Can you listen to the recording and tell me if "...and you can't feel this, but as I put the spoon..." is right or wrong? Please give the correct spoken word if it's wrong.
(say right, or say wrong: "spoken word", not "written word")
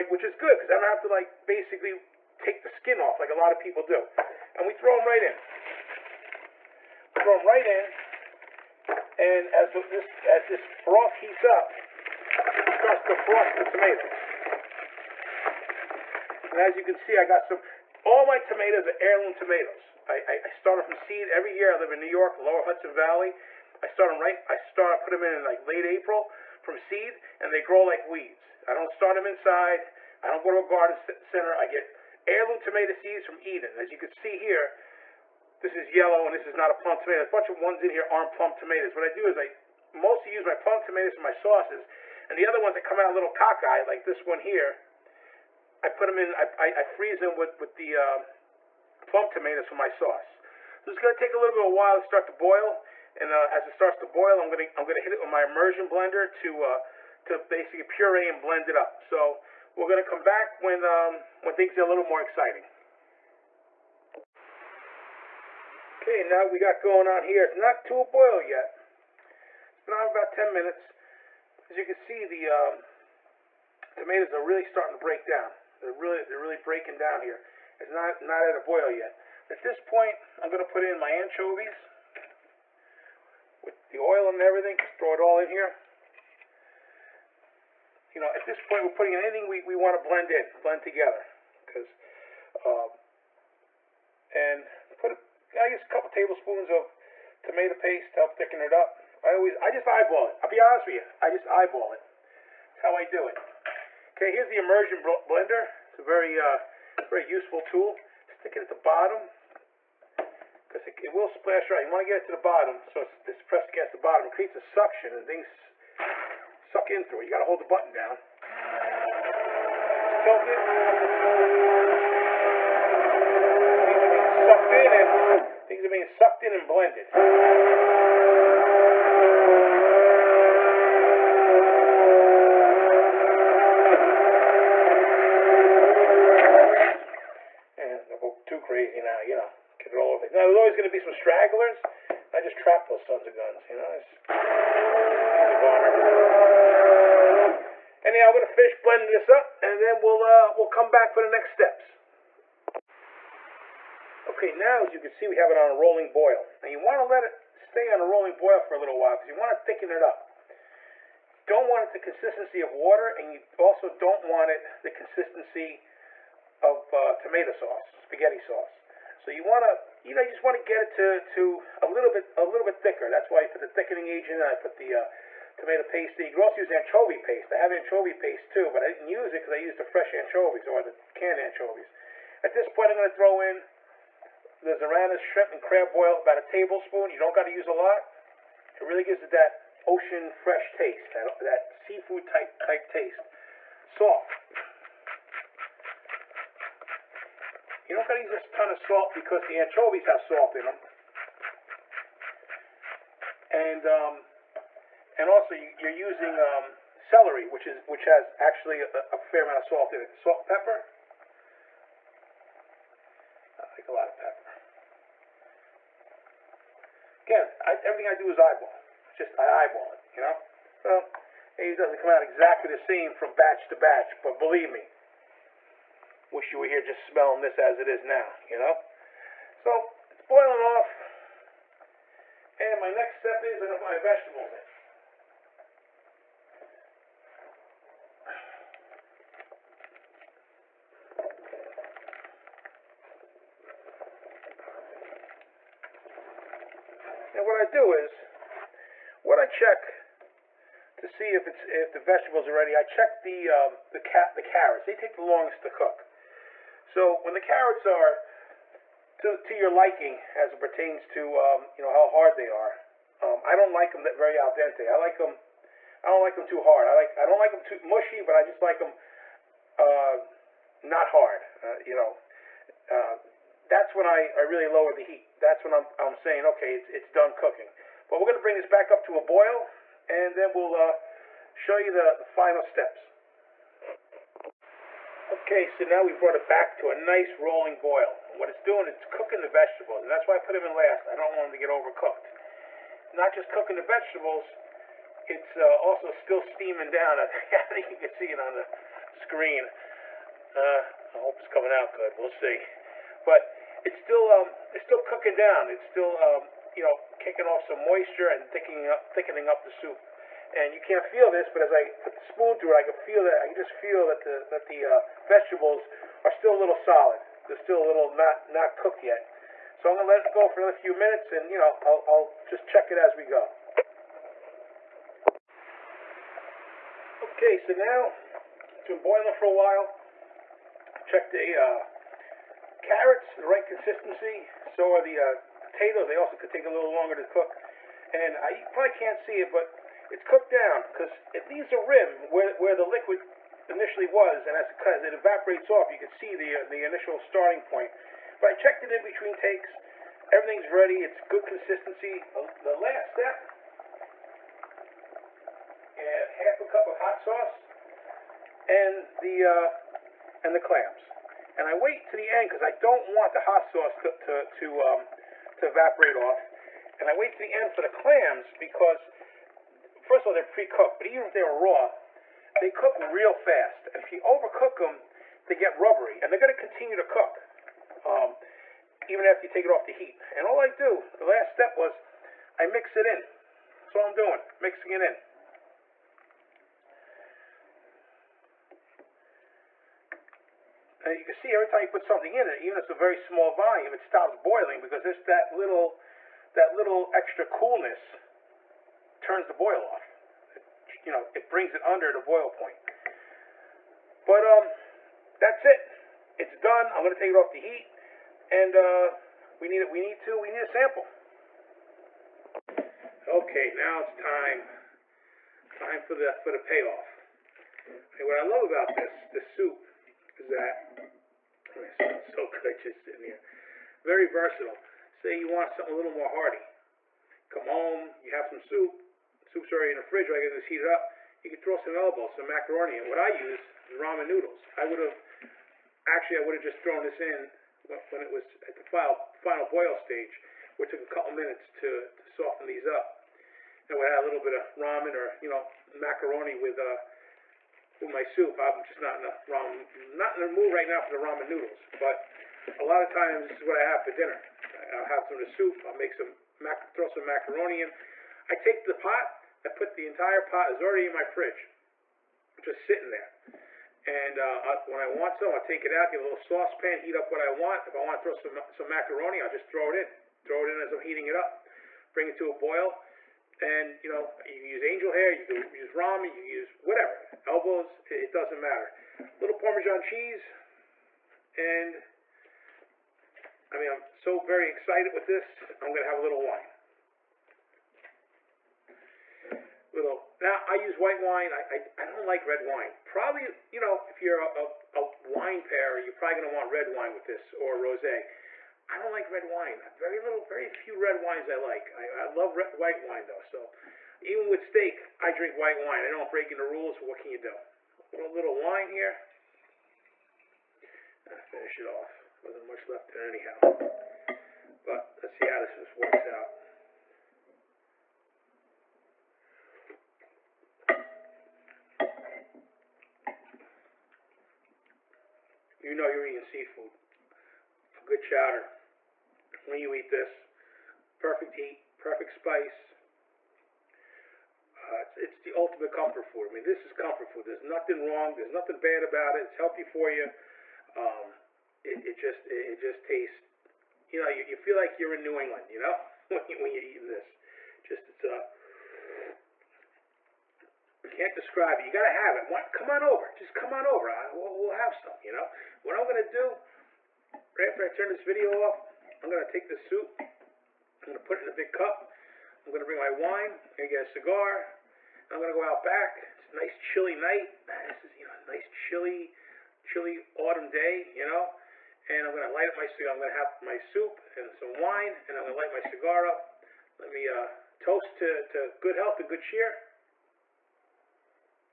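right.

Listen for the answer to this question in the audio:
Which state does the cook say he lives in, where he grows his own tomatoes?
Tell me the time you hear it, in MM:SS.
00:21.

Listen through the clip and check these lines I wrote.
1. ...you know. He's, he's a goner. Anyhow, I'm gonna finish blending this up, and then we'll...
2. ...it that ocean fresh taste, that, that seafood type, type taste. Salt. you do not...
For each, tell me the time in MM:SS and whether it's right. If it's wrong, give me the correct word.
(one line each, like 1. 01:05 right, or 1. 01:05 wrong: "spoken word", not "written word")
1. 02:23 right
2. 03:09 right.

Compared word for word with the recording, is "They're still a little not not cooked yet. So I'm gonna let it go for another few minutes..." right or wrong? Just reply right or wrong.
right.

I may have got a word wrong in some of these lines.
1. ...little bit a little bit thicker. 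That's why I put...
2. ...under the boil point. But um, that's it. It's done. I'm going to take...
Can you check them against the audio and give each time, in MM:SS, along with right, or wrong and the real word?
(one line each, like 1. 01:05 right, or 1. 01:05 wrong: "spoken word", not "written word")
1. 02:51 right
2. 06:41 right.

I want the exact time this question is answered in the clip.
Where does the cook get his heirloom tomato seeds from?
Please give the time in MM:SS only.
00:33.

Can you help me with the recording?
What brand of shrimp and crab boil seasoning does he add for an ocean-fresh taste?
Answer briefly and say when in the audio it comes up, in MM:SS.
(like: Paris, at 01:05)
Zarana's, at 03:04.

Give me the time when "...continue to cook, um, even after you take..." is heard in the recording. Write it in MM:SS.
06:16.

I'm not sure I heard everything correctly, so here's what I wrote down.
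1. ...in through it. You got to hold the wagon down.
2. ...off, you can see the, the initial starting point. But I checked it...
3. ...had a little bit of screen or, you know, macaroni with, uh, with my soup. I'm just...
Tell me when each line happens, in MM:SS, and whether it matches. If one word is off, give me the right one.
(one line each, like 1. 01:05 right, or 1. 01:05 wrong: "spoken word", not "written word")
1. 01:56 wrong: "button", not "wagon"
2. 05:45 right
3. 07:24 wrong: "ramen", not "screen".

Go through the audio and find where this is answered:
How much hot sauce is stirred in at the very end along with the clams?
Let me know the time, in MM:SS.
05:56.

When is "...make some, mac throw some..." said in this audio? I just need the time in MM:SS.
07:35.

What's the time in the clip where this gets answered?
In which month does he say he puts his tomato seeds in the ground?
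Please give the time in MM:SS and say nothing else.
00:25.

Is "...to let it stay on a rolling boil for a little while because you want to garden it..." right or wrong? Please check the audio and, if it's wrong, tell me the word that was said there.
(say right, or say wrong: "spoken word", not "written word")
wrong: "thicken", not "garden".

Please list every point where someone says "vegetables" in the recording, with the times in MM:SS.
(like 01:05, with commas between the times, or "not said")
03:53, 04:11, 04:49, 04:53, 05:15.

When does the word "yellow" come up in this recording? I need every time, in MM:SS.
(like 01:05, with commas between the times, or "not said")
00:35.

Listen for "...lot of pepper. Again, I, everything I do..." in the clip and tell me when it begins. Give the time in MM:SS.
03:33.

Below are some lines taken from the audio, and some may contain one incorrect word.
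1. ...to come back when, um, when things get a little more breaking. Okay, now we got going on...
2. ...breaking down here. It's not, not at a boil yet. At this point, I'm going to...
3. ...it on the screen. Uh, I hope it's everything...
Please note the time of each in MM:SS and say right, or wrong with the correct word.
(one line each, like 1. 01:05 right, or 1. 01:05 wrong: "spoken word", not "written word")
1. 01:00 wrong: "exciting", not "breaking"
2. 01:16 right
3. 04:58 wrong: "coming", not "everything".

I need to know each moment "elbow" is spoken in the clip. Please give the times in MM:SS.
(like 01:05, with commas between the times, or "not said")
07:11, 07:57.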